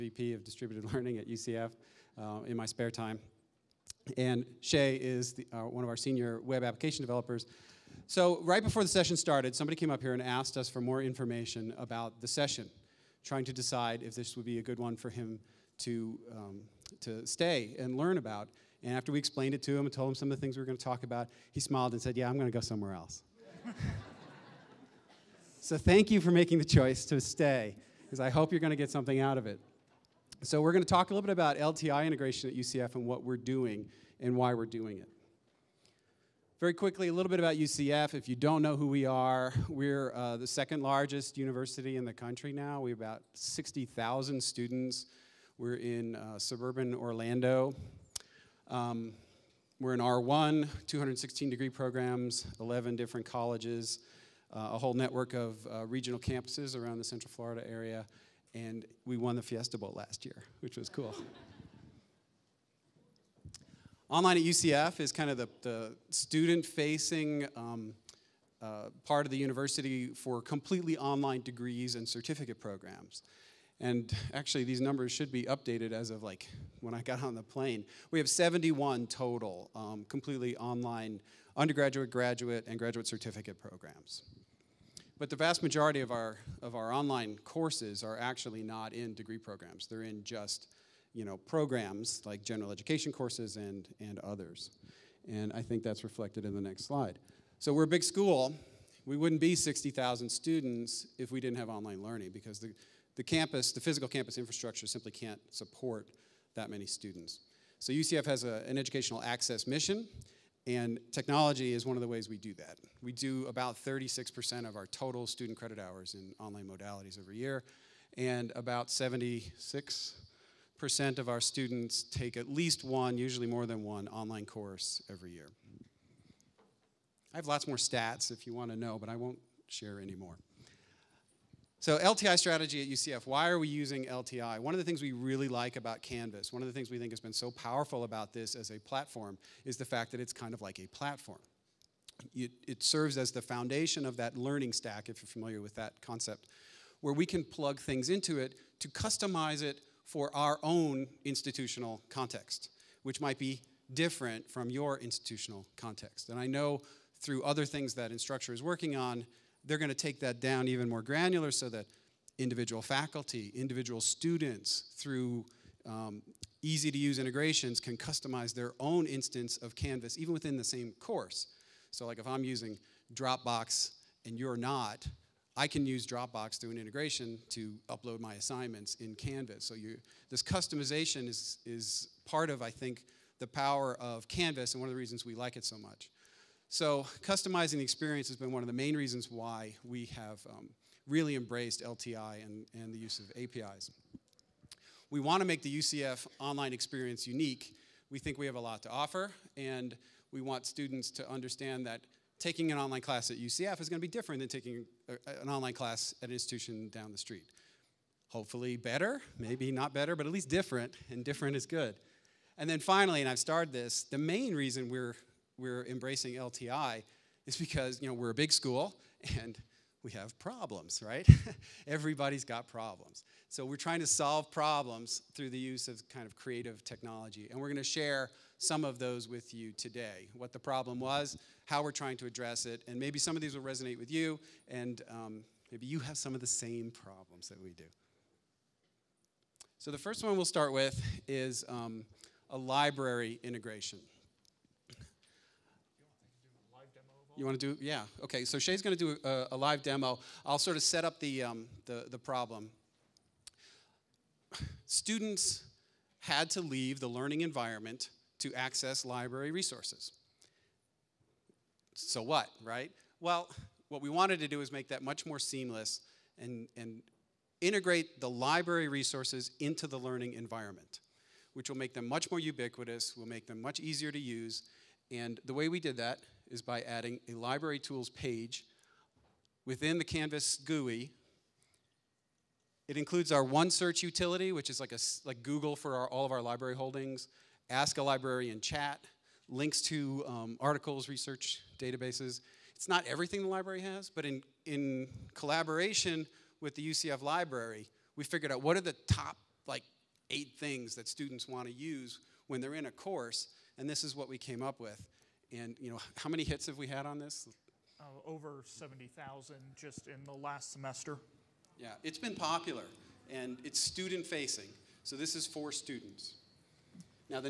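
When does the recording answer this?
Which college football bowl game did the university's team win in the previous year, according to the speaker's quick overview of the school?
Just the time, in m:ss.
0:59.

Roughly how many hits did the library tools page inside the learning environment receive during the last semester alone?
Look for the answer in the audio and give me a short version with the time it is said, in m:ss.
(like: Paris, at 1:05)
over 70,000, at 5:08.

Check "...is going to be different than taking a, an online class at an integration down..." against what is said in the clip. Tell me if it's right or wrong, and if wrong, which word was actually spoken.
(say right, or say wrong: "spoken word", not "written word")
wrong: "institution", not "integration".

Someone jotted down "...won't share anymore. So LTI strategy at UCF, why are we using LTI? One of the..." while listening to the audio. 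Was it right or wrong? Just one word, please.
right.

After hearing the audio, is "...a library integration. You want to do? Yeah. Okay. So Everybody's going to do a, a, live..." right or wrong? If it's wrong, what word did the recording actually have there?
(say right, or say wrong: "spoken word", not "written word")
wrong: "Shea", not "Everybody".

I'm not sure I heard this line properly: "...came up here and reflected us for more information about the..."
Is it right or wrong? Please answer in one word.
wrong.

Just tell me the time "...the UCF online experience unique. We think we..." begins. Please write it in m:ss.
3:15.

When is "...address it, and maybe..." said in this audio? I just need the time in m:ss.
3:52.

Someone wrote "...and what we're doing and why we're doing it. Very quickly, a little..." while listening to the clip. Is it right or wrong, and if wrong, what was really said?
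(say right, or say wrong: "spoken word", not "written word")
right.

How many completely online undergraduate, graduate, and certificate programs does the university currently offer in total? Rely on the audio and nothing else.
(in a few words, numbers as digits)
71.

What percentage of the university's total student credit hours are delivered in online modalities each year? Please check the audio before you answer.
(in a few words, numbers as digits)
36%.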